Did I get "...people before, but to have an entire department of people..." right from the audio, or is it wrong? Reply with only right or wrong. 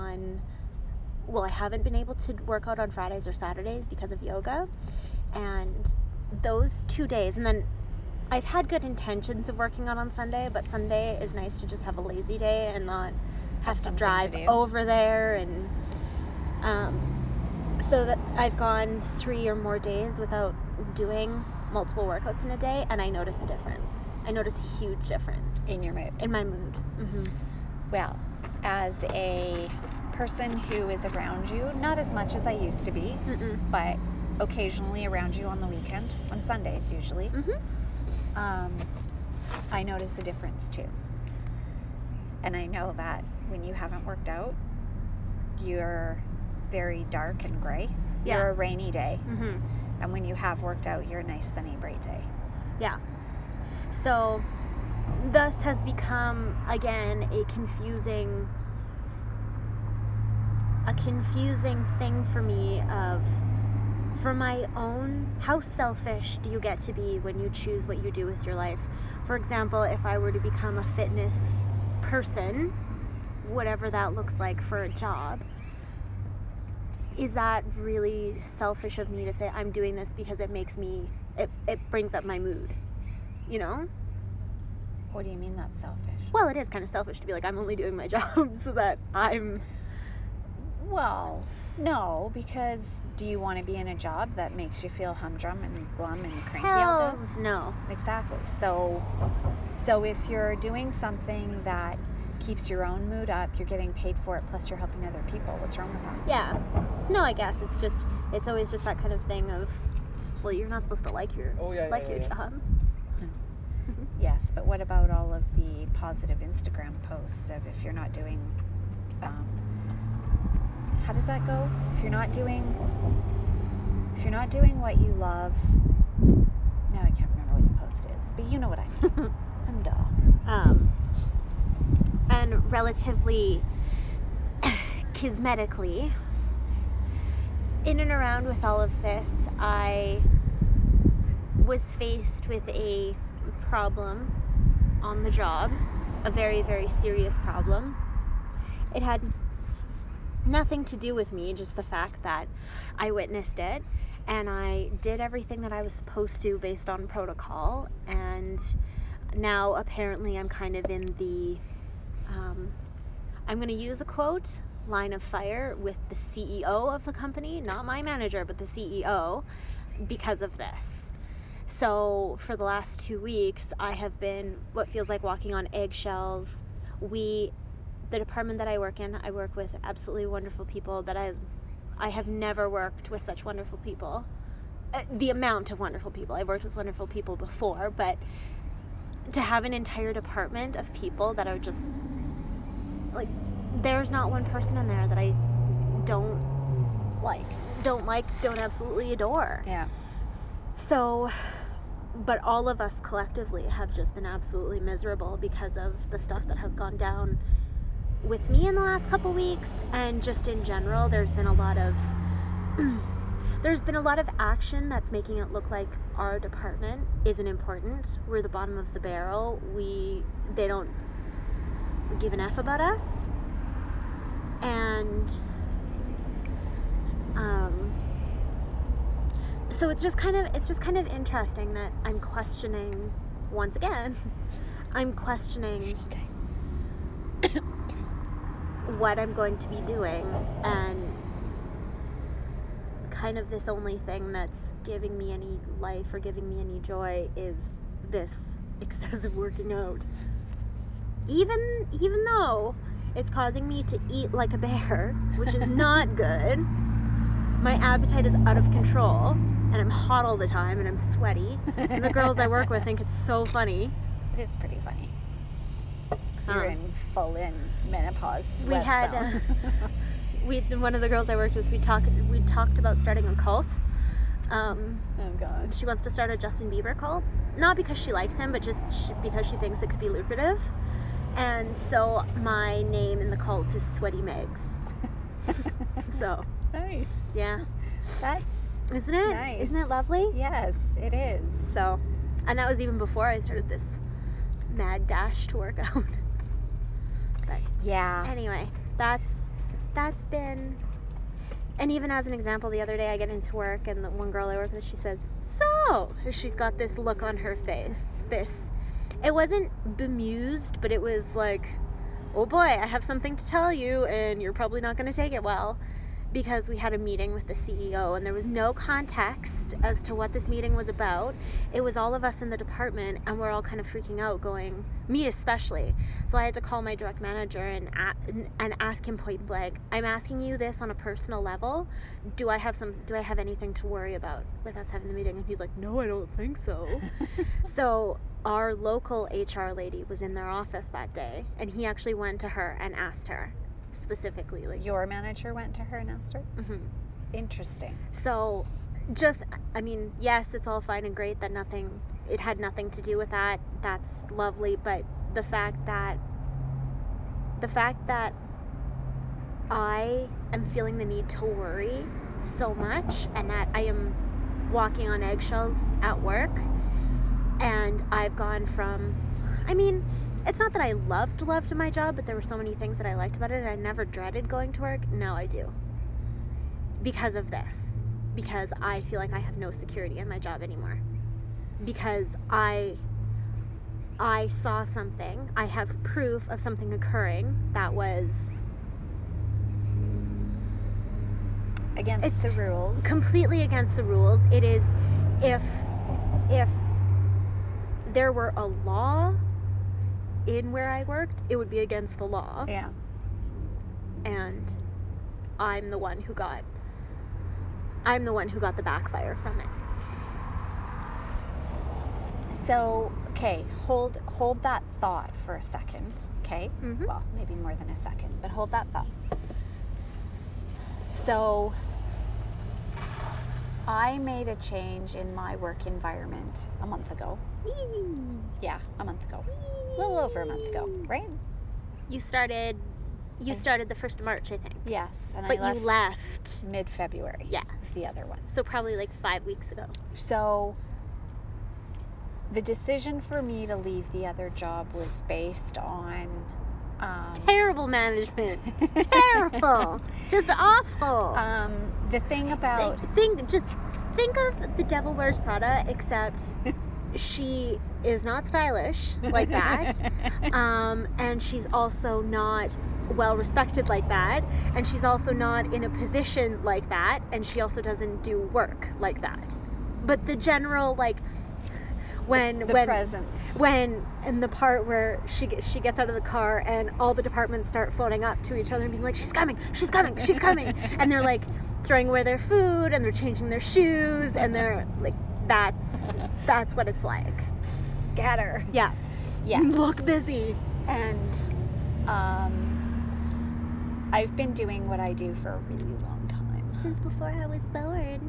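right.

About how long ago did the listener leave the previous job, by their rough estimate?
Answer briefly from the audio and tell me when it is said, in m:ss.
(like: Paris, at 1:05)
5 weeks ago, at 7:19.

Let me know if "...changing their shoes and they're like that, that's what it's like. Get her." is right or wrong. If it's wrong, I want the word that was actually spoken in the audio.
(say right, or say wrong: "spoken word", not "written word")
right.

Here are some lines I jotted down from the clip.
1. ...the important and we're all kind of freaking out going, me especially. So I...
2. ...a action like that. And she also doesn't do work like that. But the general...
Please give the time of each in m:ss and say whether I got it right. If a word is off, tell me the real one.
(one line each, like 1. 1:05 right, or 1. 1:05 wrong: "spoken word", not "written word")
1. 5:22 wrong: "department", not "important"
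2. 7:45 wrong: "position", not "action".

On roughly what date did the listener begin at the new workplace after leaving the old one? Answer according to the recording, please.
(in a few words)
March 1.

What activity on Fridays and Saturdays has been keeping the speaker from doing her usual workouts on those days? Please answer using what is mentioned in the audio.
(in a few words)
yoga.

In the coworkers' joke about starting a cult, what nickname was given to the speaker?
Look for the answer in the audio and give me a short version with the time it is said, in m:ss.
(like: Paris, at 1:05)
Sweaty Megs, at 4:43.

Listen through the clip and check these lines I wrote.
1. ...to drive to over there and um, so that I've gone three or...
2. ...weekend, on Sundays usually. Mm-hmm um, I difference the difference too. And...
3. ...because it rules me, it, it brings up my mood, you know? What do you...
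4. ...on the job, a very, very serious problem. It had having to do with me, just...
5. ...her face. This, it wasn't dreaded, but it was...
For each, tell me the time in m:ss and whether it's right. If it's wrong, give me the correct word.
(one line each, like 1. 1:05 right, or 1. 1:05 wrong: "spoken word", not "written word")
1. 0:13 right
2. 0:35 wrong: "notice", not "difference"
3. 1:20 wrong: "makes", not "rules"
4. 2:25 wrong: "nothing", not "having"
5. 5:07 wrong: "bemused", not "dreaded".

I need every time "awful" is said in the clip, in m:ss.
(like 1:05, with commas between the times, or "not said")
7:30.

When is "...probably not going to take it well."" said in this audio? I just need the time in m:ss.
5:14.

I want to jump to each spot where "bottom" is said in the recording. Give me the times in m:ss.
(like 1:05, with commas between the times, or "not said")
3:38.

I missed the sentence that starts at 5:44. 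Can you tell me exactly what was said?
Like your manager went to her and asked her.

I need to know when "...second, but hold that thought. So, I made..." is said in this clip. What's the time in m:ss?
6:58.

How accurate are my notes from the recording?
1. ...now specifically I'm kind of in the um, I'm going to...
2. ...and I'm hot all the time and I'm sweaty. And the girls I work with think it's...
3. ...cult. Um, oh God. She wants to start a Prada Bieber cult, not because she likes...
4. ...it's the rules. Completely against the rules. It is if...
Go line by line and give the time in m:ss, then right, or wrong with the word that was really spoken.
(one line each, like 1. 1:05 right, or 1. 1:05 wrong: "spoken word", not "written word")
1. 2:39 wrong: "apparently", not "specifically"
2. 4:19 right
3. 4:33 wrong: "Justin", not "Prada"
4. 6:32 right.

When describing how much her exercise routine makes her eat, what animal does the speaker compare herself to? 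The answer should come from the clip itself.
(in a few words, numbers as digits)
bear.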